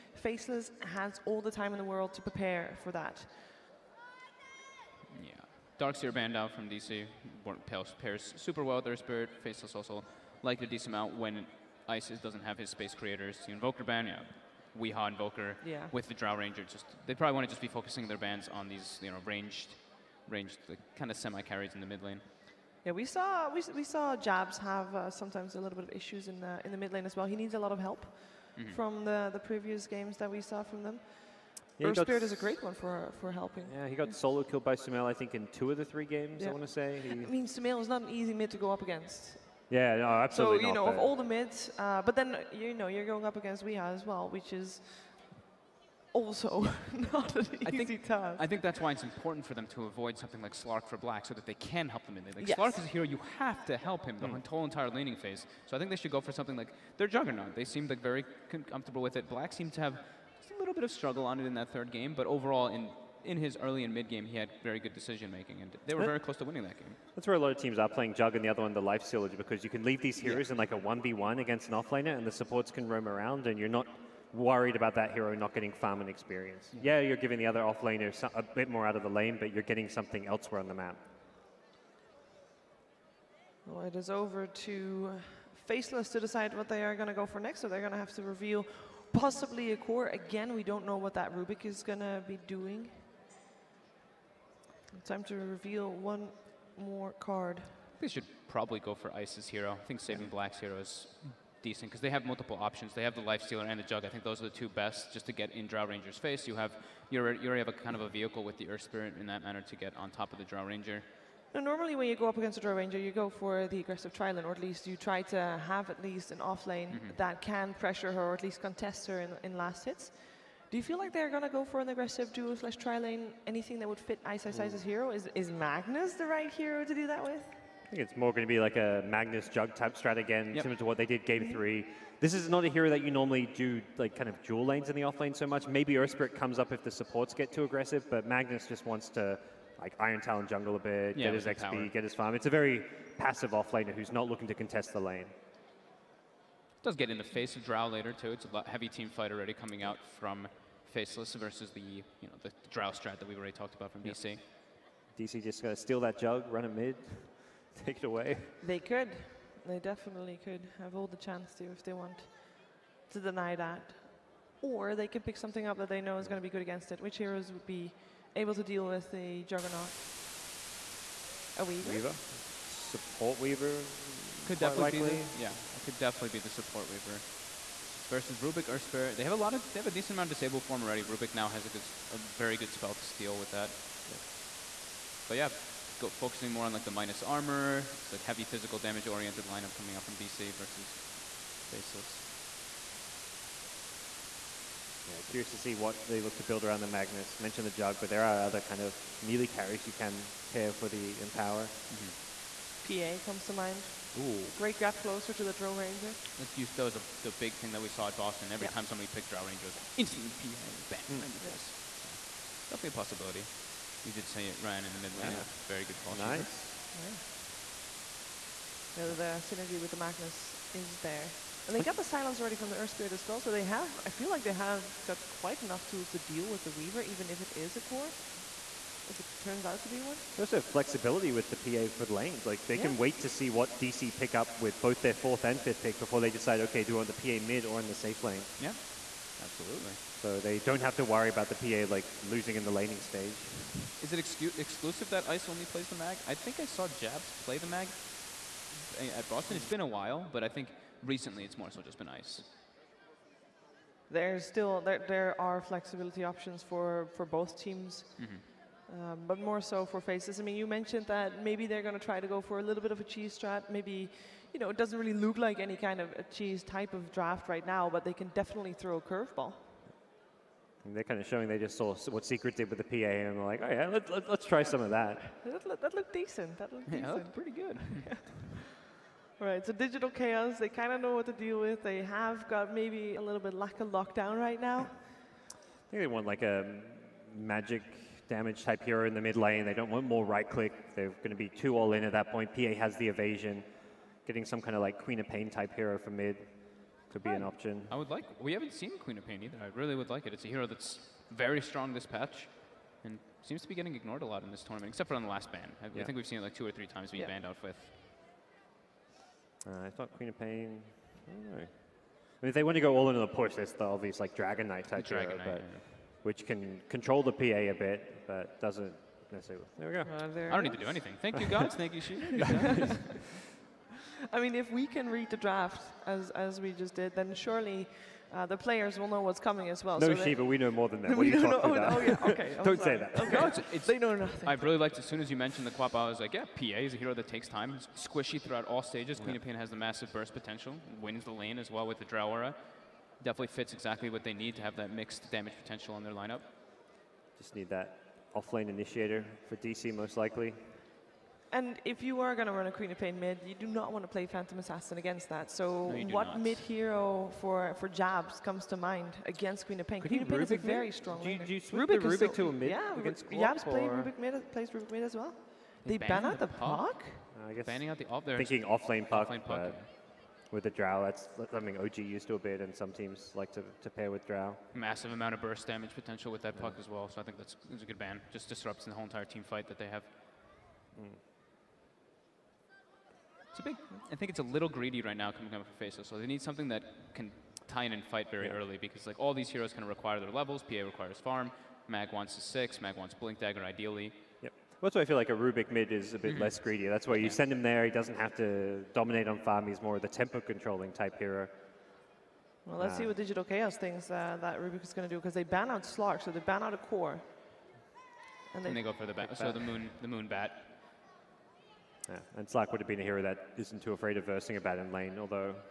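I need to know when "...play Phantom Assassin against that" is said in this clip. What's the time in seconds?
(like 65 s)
354 s.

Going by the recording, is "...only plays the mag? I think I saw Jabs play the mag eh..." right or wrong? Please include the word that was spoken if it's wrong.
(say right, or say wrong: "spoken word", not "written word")
right.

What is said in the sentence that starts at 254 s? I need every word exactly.
There's still there, there are flexibility options for for both teams.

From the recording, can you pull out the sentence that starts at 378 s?
Just disrupts the whole entire team fight that they have.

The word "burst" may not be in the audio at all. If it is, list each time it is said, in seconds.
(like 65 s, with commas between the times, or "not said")
340 s, 375 s.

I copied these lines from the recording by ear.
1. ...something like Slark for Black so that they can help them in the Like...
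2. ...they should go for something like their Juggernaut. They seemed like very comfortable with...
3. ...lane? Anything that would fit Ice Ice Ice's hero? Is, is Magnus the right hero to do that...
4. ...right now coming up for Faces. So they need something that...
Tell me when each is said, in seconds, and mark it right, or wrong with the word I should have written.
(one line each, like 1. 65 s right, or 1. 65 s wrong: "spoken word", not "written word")
1. 50 s right
2. 55 s right
3. 122 s right
4. 385 s right.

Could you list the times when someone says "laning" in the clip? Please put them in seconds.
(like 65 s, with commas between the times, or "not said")
54 s, 242 s.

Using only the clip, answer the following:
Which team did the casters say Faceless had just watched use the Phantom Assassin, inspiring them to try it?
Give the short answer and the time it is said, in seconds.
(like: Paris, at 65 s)
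Secret, at 272 s.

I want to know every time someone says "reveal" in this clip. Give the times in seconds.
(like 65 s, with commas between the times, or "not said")
88 s, 95 s.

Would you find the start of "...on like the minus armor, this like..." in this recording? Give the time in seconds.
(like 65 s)
186 s.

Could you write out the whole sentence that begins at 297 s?
I would like, we haven't seen Queen of Pain either.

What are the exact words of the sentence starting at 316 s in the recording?
which can control the PA a bit, but doesn't necessarily.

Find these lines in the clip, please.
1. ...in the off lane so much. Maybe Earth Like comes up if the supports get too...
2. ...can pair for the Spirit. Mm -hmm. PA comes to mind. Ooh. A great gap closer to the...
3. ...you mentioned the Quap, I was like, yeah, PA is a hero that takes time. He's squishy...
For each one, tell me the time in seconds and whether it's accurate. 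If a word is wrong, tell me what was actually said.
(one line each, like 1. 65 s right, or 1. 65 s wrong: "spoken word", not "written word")
1. 134 s wrong: "Spirit", not "Like"
2. 199 s wrong: "Empower", not "Spirit"
3. 335 s right.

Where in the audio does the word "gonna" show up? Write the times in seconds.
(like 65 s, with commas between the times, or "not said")
155 s.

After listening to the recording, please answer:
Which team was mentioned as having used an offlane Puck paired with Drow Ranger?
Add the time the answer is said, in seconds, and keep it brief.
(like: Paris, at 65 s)
OG, at 371 s.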